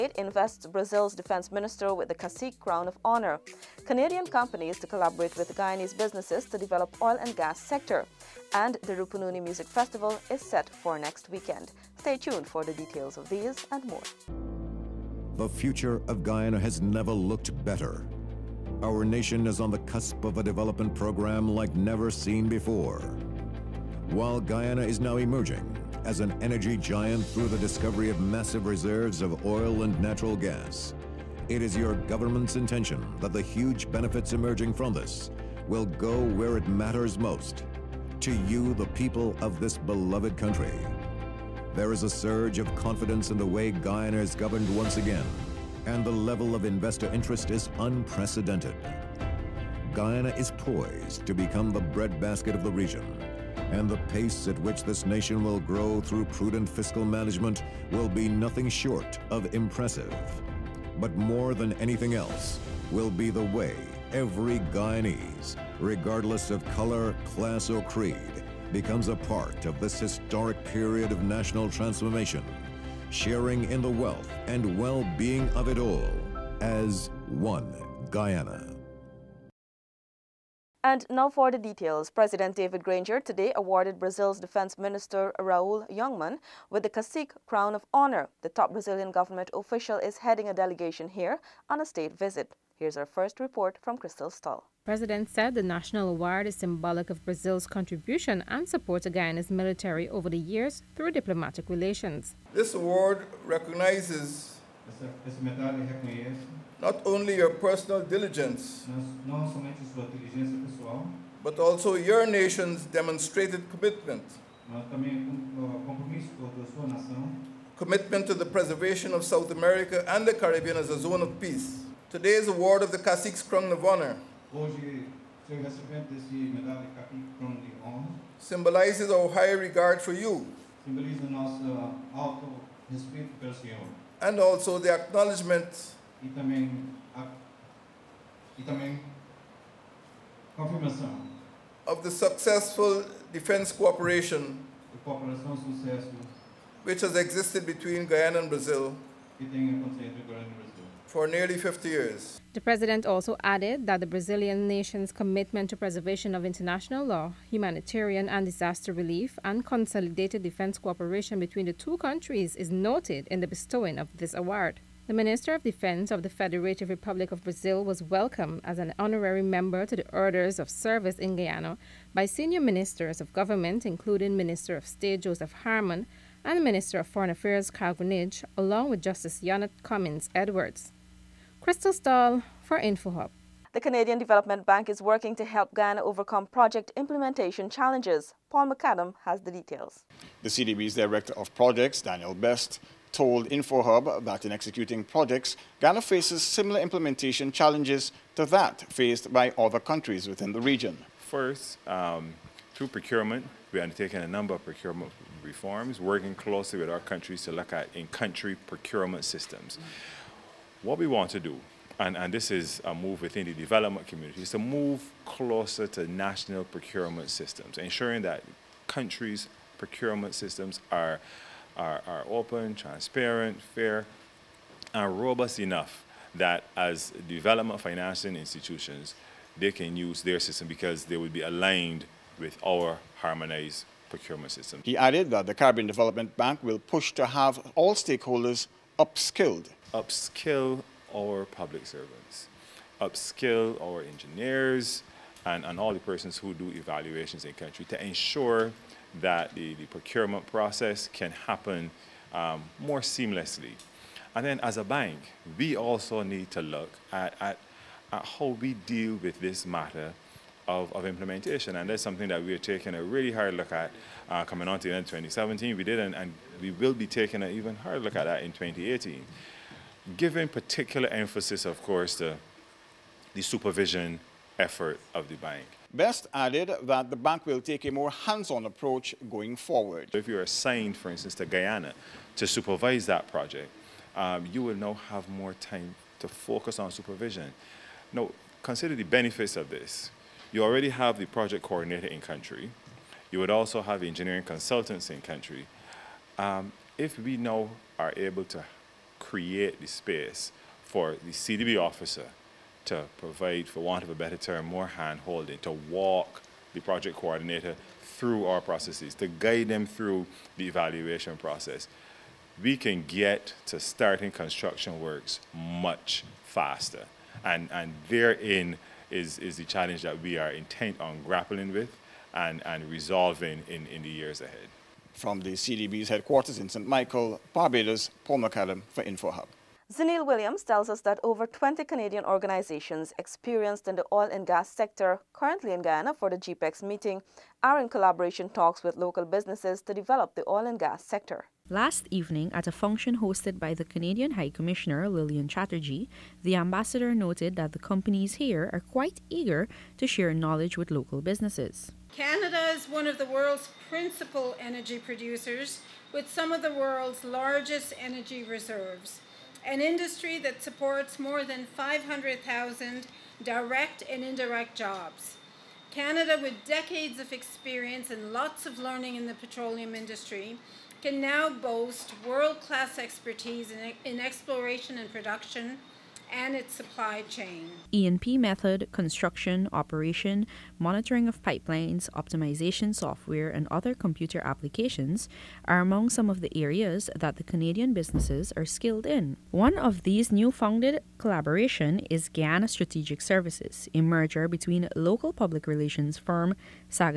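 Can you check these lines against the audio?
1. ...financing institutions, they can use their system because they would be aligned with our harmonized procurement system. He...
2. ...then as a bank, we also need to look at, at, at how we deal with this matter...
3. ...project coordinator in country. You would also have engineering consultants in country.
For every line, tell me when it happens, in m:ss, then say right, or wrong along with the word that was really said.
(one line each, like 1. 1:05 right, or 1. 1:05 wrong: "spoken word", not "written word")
1. 3:47 right
2. 4:14 right
3. 4:51 right.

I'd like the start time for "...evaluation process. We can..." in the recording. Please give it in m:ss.
5:10.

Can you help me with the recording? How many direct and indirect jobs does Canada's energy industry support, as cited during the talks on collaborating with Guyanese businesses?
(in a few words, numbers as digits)
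more than 500,000.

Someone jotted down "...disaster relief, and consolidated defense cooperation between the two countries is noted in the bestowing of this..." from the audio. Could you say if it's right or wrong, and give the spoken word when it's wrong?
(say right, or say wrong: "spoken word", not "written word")
right.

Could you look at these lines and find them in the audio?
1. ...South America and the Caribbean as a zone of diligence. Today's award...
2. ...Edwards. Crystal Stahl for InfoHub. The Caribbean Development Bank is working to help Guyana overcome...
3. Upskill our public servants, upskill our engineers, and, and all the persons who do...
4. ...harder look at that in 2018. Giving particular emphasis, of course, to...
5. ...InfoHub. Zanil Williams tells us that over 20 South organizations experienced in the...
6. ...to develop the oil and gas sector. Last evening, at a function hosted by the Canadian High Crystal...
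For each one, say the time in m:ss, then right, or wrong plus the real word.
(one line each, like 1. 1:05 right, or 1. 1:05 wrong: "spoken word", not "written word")
1. 1:59 wrong: "peace", not "diligence"
2. 3:00 right
3. 3:59 right
4. 4:27 right
5. 5:29 wrong: "Canadian", not "South"
6. 5:39 wrong: "Commissioner", not "Crystal".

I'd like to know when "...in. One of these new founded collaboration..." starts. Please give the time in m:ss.
6:29.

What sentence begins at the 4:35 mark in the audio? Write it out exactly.
Best added that the bank will take a more hands-on approach going forward.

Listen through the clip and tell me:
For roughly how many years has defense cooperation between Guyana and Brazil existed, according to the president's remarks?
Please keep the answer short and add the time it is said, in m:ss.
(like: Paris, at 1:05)
nearly 50 years, at 2:31.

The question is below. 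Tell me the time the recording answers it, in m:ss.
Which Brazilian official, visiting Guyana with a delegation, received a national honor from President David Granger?
1:25.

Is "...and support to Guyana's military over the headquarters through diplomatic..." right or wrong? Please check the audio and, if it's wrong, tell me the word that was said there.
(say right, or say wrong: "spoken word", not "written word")
wrong: "years", not "headquarters".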